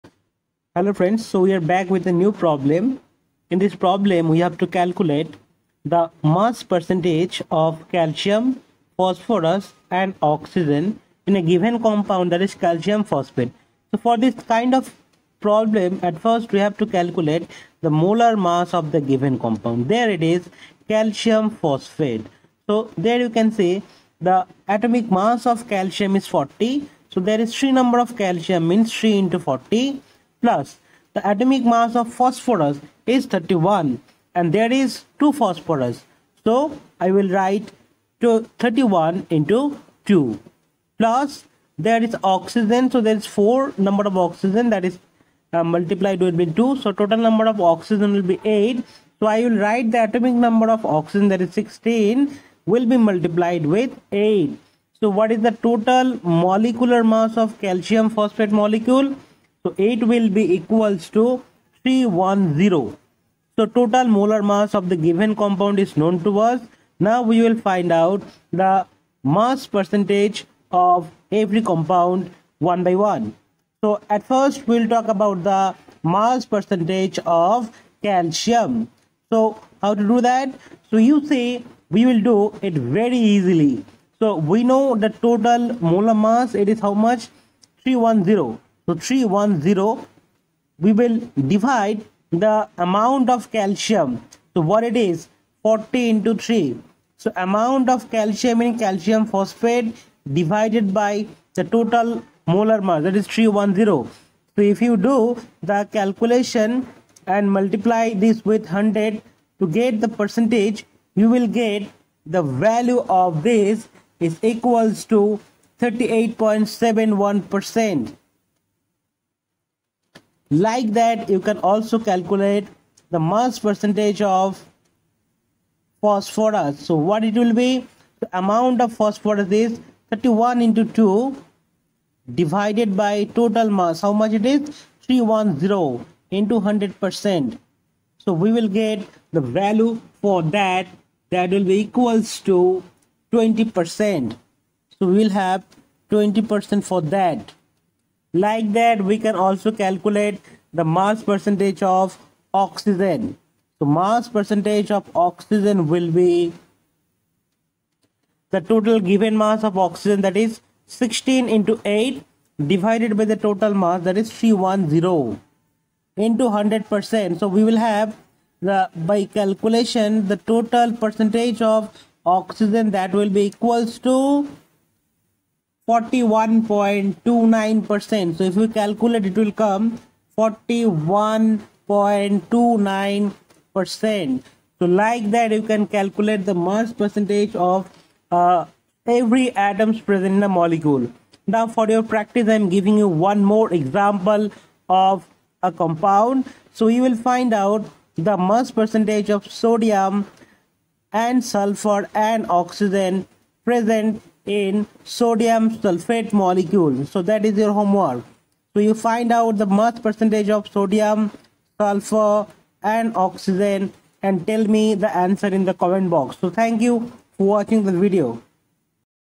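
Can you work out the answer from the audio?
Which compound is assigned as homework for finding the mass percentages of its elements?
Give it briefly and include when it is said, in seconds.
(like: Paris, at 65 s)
sodium sulfate, at 205 s.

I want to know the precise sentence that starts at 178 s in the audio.
So if we calculate, it will come 41.29%.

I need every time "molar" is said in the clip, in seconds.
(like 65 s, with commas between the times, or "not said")
17 s, 64 s, 85 s, 102 s.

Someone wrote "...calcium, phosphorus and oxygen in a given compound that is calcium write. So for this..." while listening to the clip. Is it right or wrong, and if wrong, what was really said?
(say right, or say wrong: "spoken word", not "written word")
wrong: "phosphate", not "write".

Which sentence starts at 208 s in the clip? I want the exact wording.
So you find out the mass percentage of sodium, sulfur and oxygen and tell me the answer in the comment box.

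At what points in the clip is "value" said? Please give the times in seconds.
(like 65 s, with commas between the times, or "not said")
112 s, 139 s.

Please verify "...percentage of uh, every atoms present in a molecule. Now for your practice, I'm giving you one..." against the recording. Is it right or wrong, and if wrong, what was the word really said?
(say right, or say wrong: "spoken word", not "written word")
right.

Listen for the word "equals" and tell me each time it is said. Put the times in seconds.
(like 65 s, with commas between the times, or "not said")
60 s, 114 s, 141 s, 173 s.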